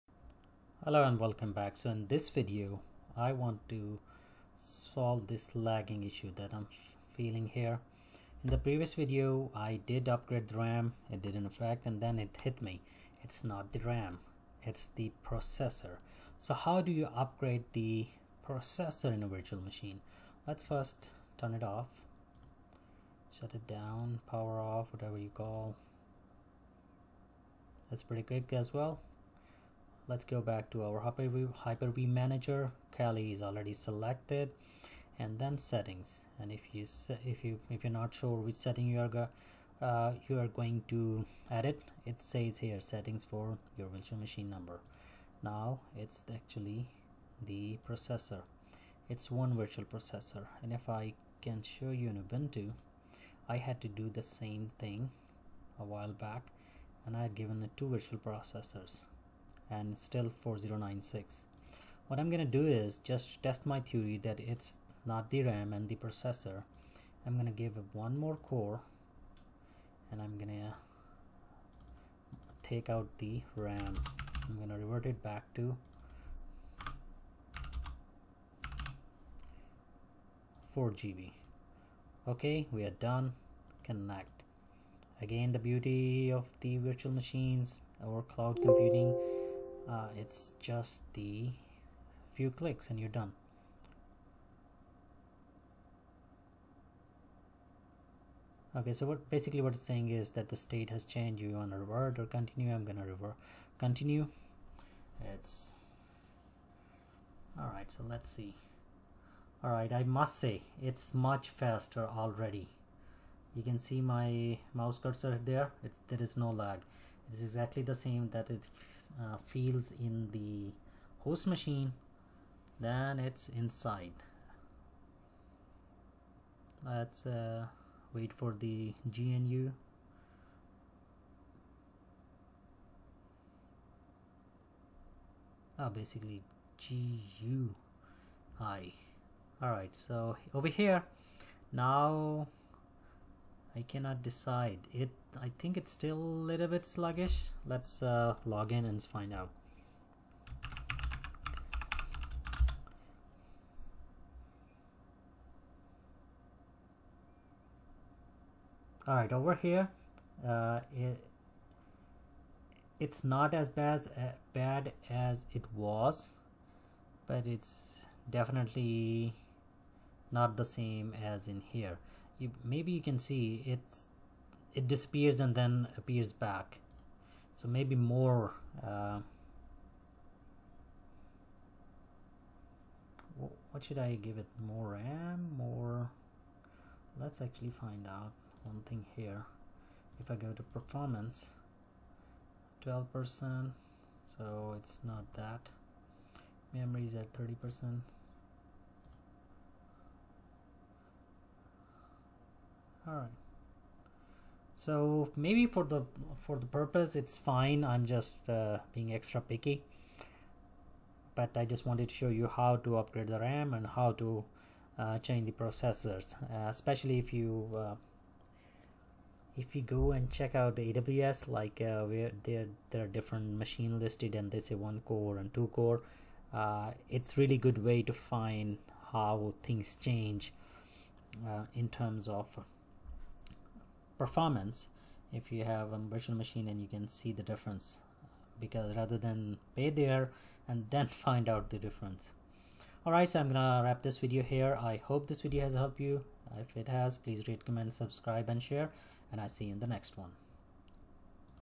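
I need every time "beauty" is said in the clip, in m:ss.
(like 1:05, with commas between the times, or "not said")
1:25.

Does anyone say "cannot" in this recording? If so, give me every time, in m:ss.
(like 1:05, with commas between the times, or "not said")
2:23.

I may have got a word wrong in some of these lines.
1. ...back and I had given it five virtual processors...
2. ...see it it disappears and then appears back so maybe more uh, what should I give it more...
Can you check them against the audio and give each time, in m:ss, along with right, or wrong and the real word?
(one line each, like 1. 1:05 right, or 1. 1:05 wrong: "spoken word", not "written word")
1. 0:56 wrong: "two", not "five"
2. 2:53 right.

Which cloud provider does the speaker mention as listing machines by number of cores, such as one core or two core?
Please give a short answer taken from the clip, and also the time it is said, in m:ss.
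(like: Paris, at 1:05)
AWS, at 3:40.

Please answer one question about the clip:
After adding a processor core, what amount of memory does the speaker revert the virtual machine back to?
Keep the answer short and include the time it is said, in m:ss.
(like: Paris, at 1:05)
4 GB, at 1:20.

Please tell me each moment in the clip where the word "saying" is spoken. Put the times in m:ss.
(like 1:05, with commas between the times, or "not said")
1:39.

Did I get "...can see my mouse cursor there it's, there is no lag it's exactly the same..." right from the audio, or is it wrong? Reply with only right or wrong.
right.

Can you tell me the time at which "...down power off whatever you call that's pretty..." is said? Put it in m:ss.
0:23.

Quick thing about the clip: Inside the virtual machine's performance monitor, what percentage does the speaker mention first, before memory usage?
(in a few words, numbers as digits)
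12%.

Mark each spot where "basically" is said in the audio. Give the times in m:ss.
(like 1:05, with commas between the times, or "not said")
1:39, 2:15.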